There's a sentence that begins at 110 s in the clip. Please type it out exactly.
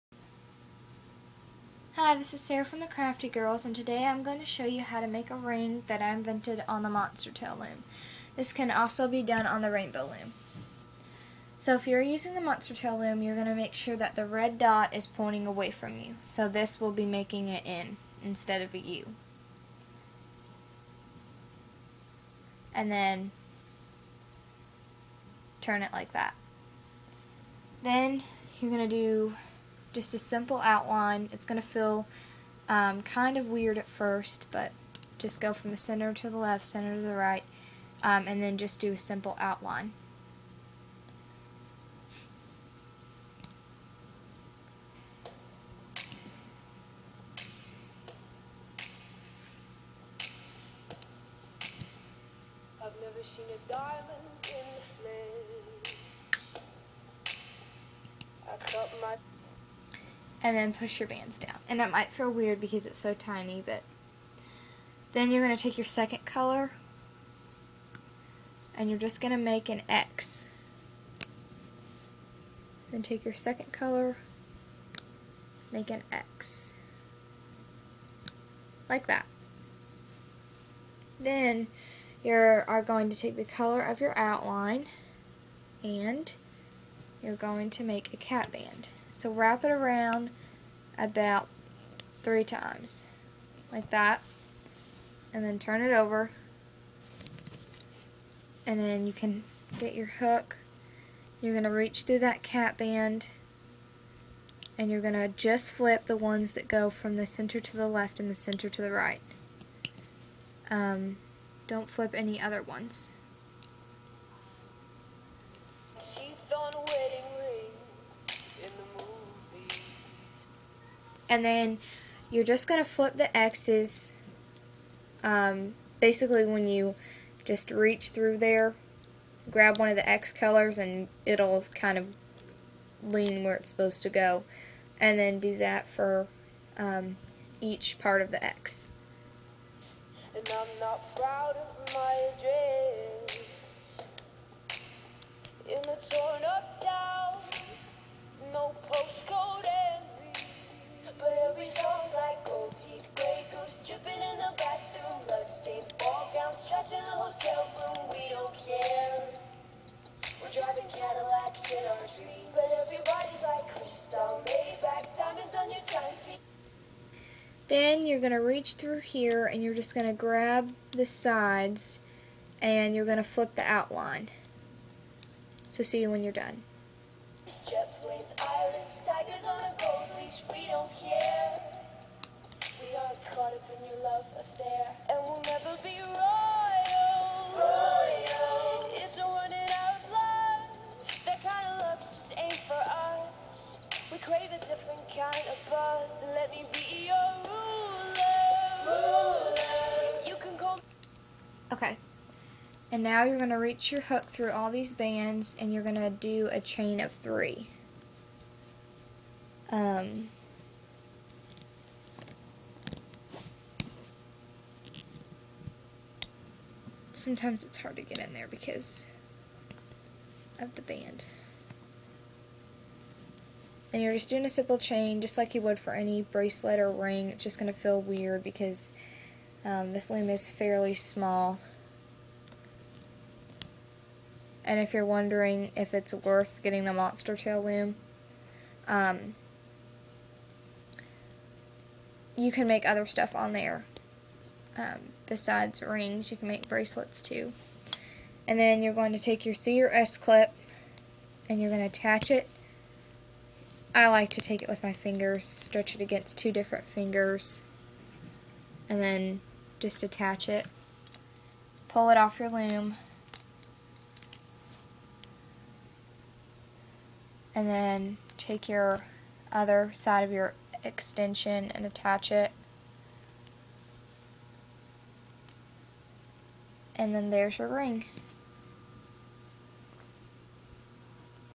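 Um, don't flip any other ones.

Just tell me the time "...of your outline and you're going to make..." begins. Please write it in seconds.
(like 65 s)
83 s.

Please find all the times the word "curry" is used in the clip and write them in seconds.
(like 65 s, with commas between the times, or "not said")
not said.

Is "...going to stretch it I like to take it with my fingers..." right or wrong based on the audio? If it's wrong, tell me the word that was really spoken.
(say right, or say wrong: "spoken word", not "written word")
wrong: "attach", not "stretch".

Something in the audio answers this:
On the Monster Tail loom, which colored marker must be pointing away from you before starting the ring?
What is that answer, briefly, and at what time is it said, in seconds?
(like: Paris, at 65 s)
red dot, at 14 s.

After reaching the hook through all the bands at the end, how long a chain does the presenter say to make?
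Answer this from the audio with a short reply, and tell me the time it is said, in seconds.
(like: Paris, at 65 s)
chain of 3, at 206 s.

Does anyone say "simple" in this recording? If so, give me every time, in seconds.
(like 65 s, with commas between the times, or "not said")
30 s, 38 s, 224 s.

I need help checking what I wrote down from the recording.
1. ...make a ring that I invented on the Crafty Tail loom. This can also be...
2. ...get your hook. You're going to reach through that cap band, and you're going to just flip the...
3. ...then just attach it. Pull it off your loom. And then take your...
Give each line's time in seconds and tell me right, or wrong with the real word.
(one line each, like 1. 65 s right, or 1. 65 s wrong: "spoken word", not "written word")
1. 5 s wrong: "Monster", not "Crafty"
2. 99 s right
3. 259 s right.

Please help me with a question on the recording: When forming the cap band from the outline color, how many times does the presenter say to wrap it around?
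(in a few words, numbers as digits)
3.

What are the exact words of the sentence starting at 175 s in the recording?
So see you when you're done.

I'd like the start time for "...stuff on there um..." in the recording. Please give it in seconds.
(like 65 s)
243 s.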